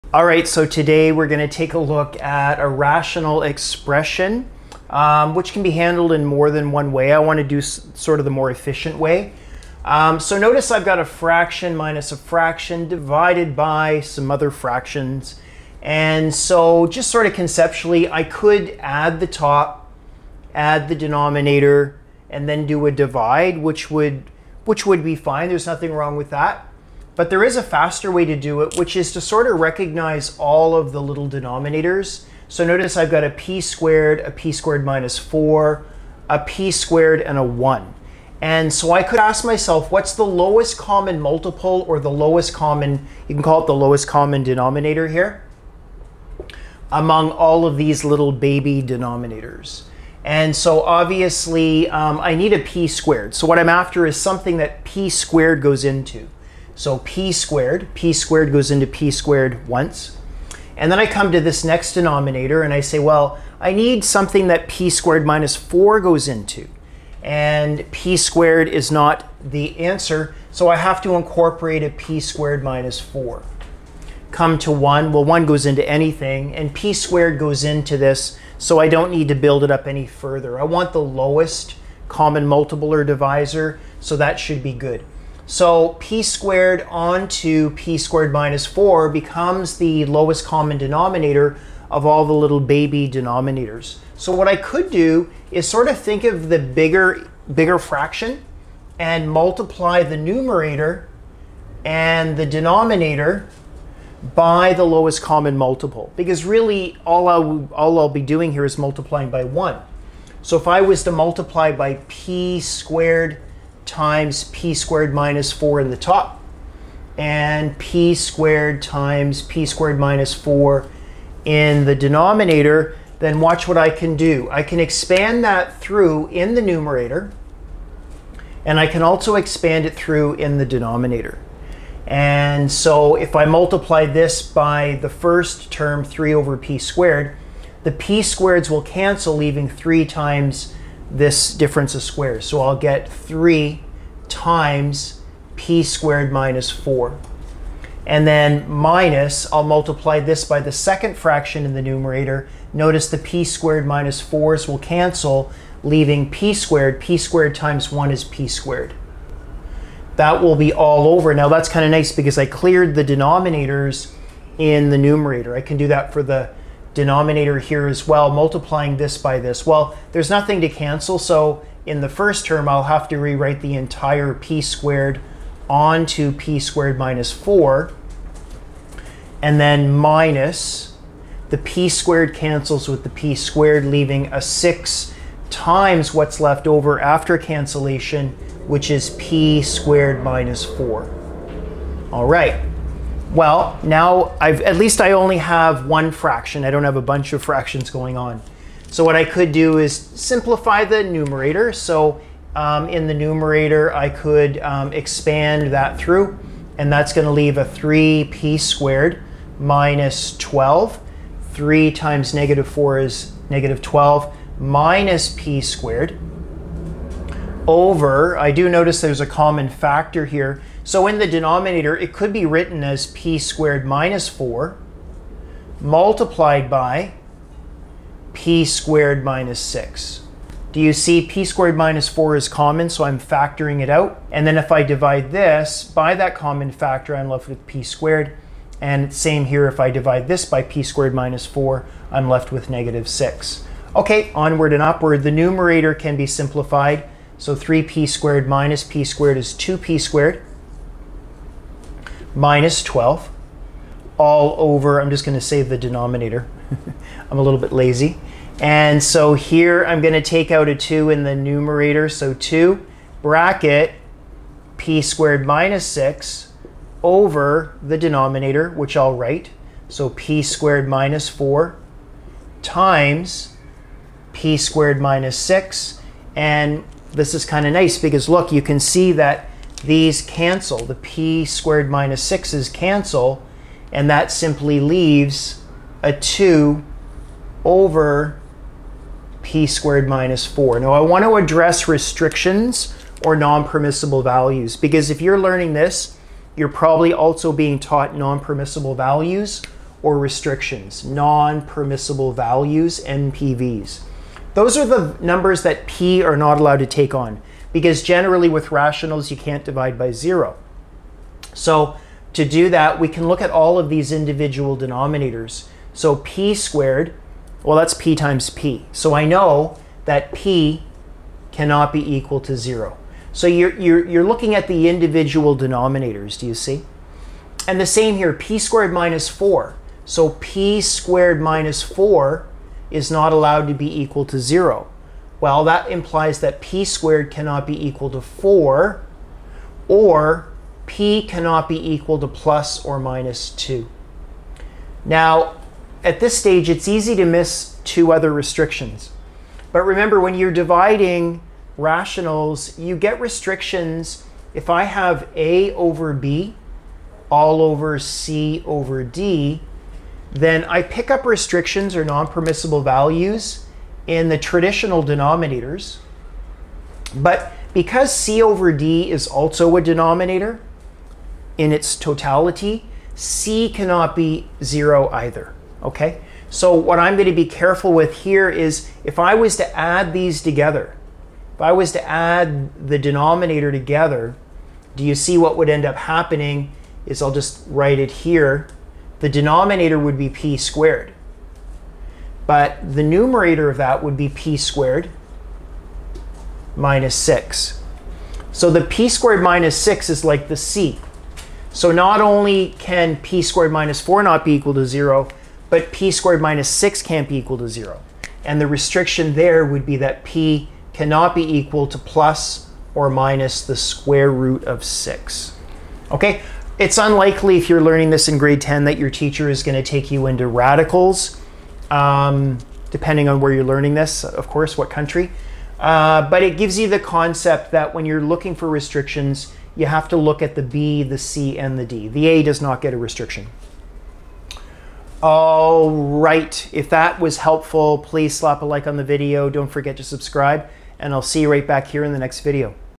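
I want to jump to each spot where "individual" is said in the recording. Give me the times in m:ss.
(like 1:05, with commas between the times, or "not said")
5:14, 5:24.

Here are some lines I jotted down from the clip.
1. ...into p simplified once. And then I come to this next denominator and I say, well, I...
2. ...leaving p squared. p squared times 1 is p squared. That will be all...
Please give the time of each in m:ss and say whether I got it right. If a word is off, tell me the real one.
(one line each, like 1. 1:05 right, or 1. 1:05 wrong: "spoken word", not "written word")
1. 0:58 wrong: "squared", not "simplified"
2. 2:35 right.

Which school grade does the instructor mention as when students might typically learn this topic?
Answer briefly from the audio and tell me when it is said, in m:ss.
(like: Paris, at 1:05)
grade 10, at 6:58.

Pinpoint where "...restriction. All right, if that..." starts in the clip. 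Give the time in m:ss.
7:12.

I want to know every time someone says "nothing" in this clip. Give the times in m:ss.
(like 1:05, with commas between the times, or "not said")
0:25, 2:50.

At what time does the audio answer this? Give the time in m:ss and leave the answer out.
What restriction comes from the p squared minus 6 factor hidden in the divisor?
6:51.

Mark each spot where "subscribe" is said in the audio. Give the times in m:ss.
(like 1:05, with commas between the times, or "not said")
7:20.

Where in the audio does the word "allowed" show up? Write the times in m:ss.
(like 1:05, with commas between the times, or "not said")
5:06, 5:33.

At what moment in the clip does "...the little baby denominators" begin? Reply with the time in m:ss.
1:32.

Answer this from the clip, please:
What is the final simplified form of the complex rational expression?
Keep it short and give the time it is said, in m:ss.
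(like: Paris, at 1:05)
2 over p squared minus 4, at 4:46.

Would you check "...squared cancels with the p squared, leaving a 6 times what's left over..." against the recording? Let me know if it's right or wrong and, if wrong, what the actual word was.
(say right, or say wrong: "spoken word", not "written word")
right.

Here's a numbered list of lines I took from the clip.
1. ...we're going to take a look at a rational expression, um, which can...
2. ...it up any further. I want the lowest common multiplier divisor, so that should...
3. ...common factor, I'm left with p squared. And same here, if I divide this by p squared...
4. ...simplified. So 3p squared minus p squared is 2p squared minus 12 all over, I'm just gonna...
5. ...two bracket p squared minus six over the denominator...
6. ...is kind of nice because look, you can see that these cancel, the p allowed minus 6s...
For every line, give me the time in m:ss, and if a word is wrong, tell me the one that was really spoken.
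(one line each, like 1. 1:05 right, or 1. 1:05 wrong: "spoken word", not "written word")
1. 0:01 right
2. 1:19 right
3. 3:56 right
4. 4:06 right
5. 4:22 right
6. 4:37 wrong: "squared", not "allowed".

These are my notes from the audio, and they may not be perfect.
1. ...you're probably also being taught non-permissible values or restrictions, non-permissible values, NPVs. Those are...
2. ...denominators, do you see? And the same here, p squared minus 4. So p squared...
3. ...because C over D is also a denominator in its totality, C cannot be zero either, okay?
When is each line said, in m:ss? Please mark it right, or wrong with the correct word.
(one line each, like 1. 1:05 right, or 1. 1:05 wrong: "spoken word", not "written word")
1. 4:56 right
2. 5:25 right
3. 6:07 right.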